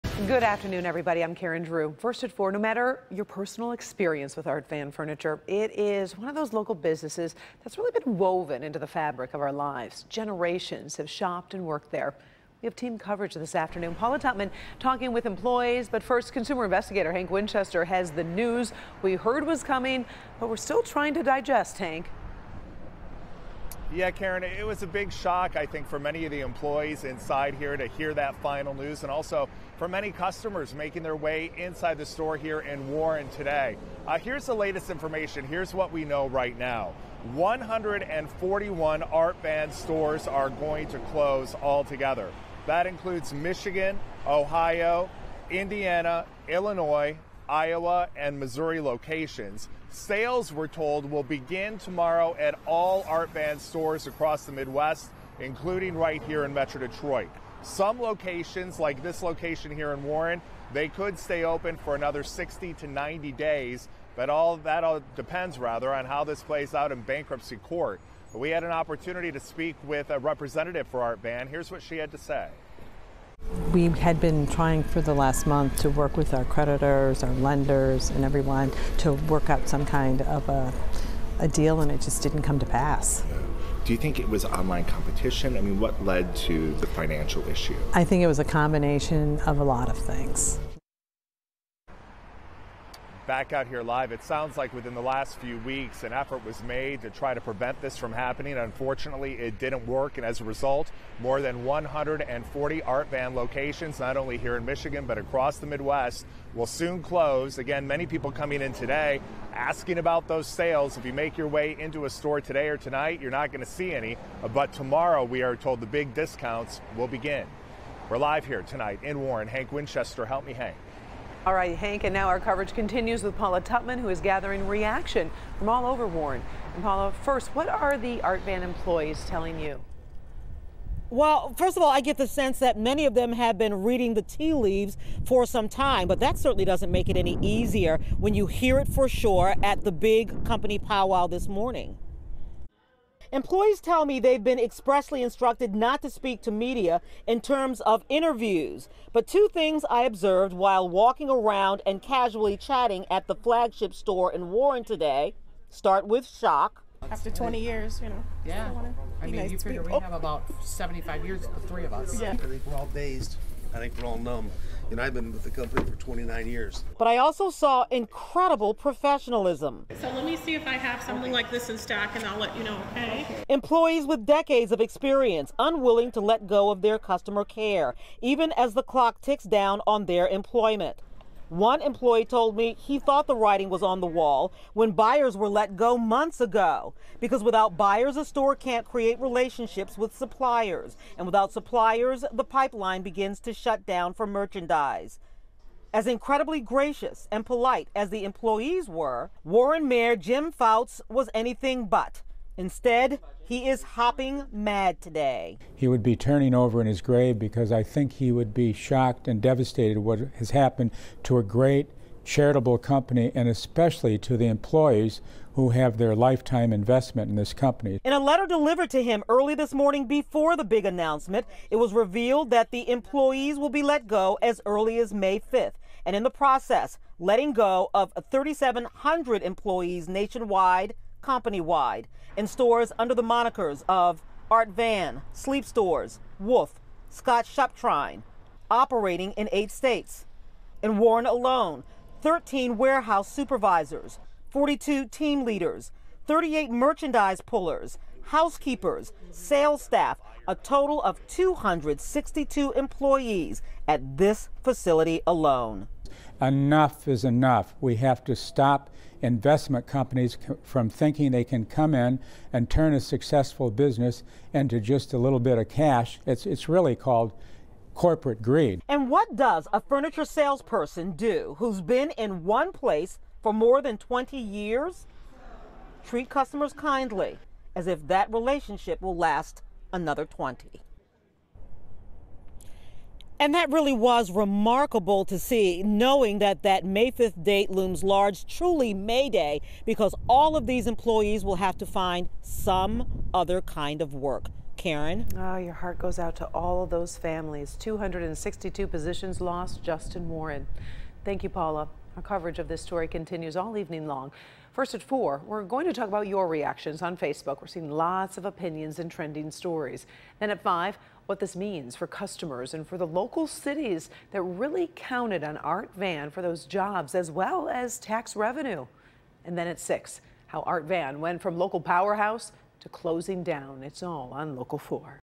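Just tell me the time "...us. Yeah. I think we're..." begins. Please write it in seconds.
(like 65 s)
161 s.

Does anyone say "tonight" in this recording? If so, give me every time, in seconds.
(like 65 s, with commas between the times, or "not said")
112 s, 118 s.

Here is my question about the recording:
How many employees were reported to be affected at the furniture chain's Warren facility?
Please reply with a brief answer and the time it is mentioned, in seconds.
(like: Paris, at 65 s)
262, at 251 s.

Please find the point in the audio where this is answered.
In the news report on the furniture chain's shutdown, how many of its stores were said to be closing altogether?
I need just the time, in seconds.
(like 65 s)
37 s.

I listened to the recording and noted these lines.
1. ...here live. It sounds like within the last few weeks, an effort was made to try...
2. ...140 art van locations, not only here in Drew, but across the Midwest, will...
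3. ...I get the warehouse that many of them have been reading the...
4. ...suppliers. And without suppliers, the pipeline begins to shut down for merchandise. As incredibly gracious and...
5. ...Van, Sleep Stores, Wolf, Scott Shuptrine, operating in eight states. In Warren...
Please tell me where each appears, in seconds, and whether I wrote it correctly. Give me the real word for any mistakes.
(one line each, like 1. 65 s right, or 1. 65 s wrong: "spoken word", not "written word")
1. 93 s right
2. 101 s wrong: "Michigan", not "Drew"
3. 131 s wrong: "sense", not "warehouse"
4. 190 s right
5. 234 s right.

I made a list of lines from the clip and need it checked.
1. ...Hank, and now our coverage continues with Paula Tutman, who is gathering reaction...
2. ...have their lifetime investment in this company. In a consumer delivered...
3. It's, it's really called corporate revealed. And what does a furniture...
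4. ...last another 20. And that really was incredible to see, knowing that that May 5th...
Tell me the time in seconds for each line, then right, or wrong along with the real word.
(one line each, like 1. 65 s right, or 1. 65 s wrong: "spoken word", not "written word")
1. 121 s right
2. 215 s wrong: "letter", not "consumer"
3. 266 s wrong: "greed", not "revealed"
4. 279 s wrong: "remarkable", not "incredible".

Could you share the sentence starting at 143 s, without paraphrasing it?
Employees tell me they've been expressly instructed not to speak to media in terms of interviews.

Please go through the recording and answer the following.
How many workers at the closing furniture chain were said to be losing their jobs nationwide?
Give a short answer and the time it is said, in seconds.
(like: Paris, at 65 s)
3700, at 228 s.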